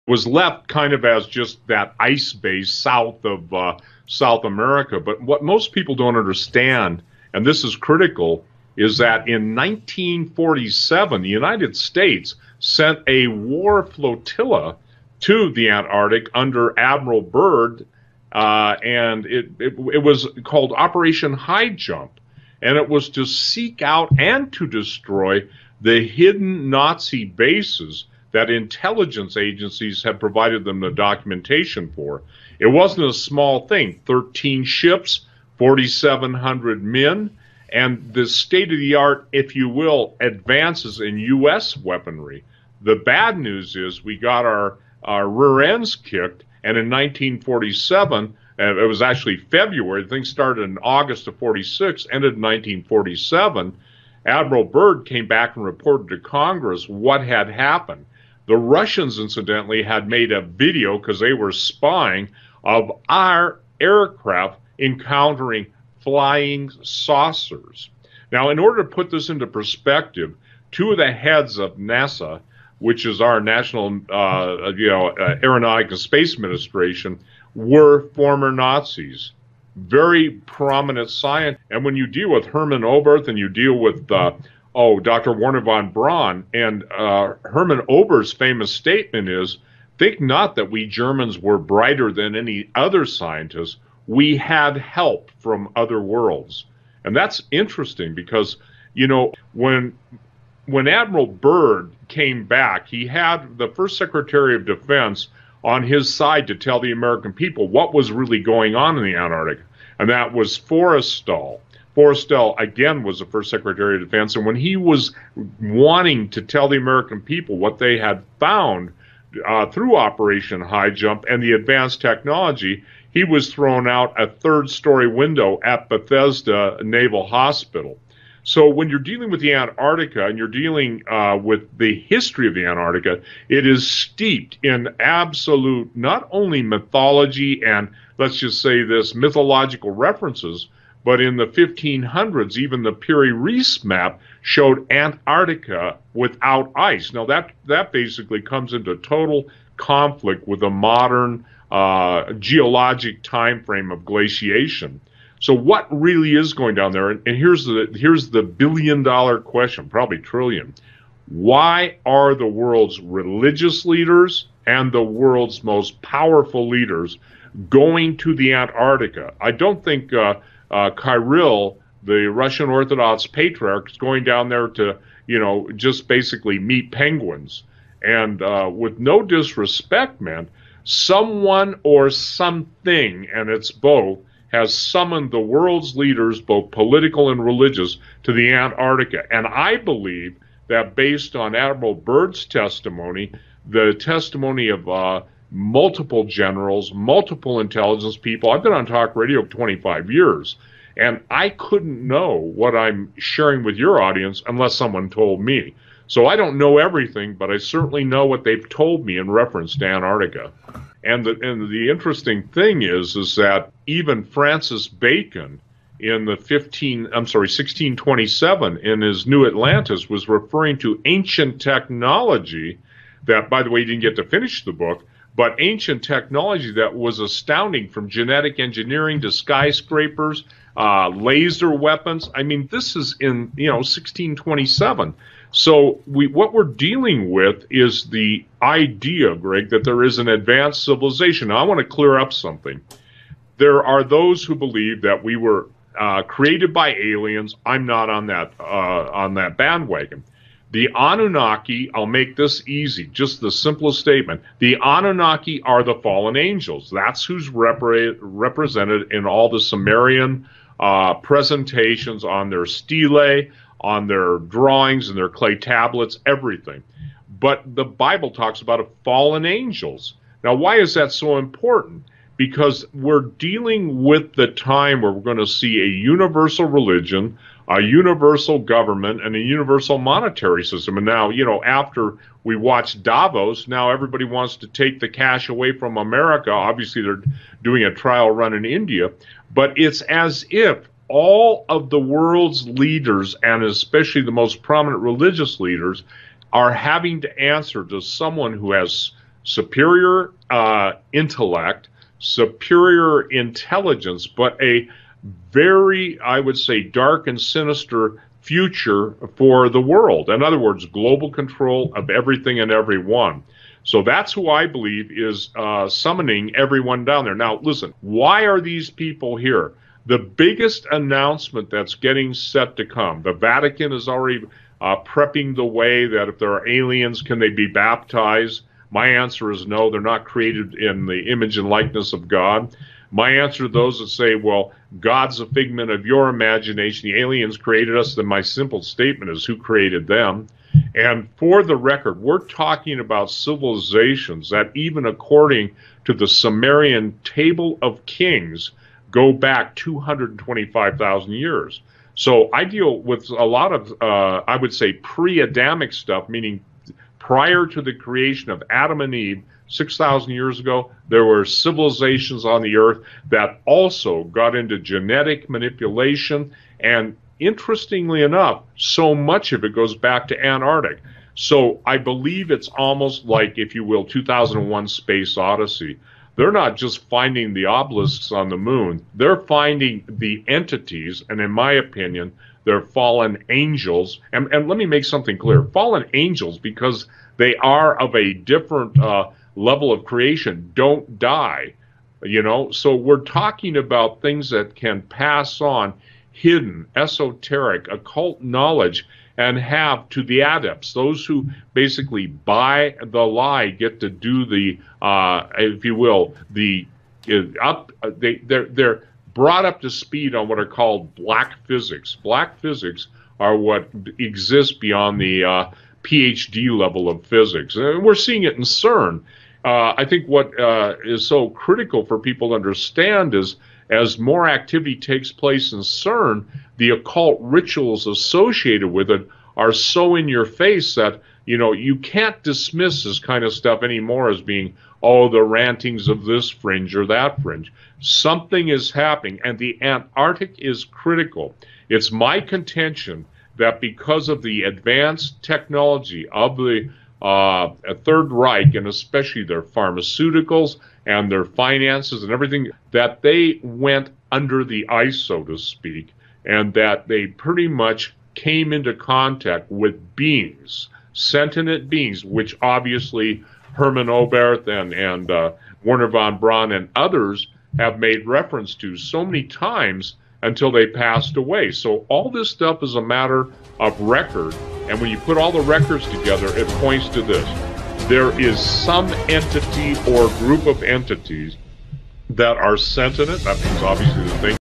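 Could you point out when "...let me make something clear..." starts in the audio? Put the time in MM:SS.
06:24.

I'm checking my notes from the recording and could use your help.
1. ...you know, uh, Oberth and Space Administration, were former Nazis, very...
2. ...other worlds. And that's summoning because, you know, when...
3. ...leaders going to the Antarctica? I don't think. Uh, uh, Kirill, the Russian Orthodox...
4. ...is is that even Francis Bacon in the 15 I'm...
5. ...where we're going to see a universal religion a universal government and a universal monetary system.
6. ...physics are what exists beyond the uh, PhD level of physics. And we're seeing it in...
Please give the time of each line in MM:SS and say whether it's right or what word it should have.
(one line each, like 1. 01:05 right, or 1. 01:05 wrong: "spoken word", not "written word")
1. 01:14 wrong: "Aeronautic", not "Oberth"
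2. 01:35 wrong: "interesting", not "summoning"
3. 02:46 right
4. 03:32 right
5. 04:35 right
6. 06:52 right.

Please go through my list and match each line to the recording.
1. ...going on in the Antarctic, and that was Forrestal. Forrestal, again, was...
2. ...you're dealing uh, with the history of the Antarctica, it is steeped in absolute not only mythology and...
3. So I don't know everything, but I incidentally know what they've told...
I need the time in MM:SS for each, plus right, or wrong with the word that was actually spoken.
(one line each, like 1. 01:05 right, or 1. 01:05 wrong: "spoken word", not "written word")
1. 01:48 right
2. 02:10 right
3. 03:26 wrong: "certainly", not "incidentally".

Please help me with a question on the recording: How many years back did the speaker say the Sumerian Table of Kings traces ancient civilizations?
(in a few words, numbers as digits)
225,000.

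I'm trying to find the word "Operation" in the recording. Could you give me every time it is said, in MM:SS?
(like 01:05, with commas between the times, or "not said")
00:20, 01:59.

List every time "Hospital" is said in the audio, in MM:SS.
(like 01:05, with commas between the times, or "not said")
02:07.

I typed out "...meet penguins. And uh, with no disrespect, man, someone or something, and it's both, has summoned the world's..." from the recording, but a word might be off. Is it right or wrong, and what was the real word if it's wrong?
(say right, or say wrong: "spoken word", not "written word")
right.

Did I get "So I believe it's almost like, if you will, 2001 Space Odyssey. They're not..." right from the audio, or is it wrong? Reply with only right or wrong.
right.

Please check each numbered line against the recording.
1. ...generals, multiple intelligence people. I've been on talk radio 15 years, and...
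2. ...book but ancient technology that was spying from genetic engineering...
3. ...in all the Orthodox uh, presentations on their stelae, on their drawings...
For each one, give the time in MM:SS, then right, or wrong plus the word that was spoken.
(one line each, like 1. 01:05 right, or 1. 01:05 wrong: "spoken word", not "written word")
1. 03:16 wrong: "25", not "15"
2. 03:44 wrong: "astounding", not "spying"
3. 04:19 wrong: "Sumerian", not "Orthodox".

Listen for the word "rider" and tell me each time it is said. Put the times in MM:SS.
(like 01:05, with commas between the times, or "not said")
not said.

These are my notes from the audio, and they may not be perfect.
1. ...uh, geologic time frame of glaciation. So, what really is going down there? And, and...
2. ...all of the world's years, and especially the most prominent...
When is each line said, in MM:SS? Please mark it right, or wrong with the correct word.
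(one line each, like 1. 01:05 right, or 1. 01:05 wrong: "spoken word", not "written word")
1. 02:31 right
2. 04:51 wrong: "leaders", not "years".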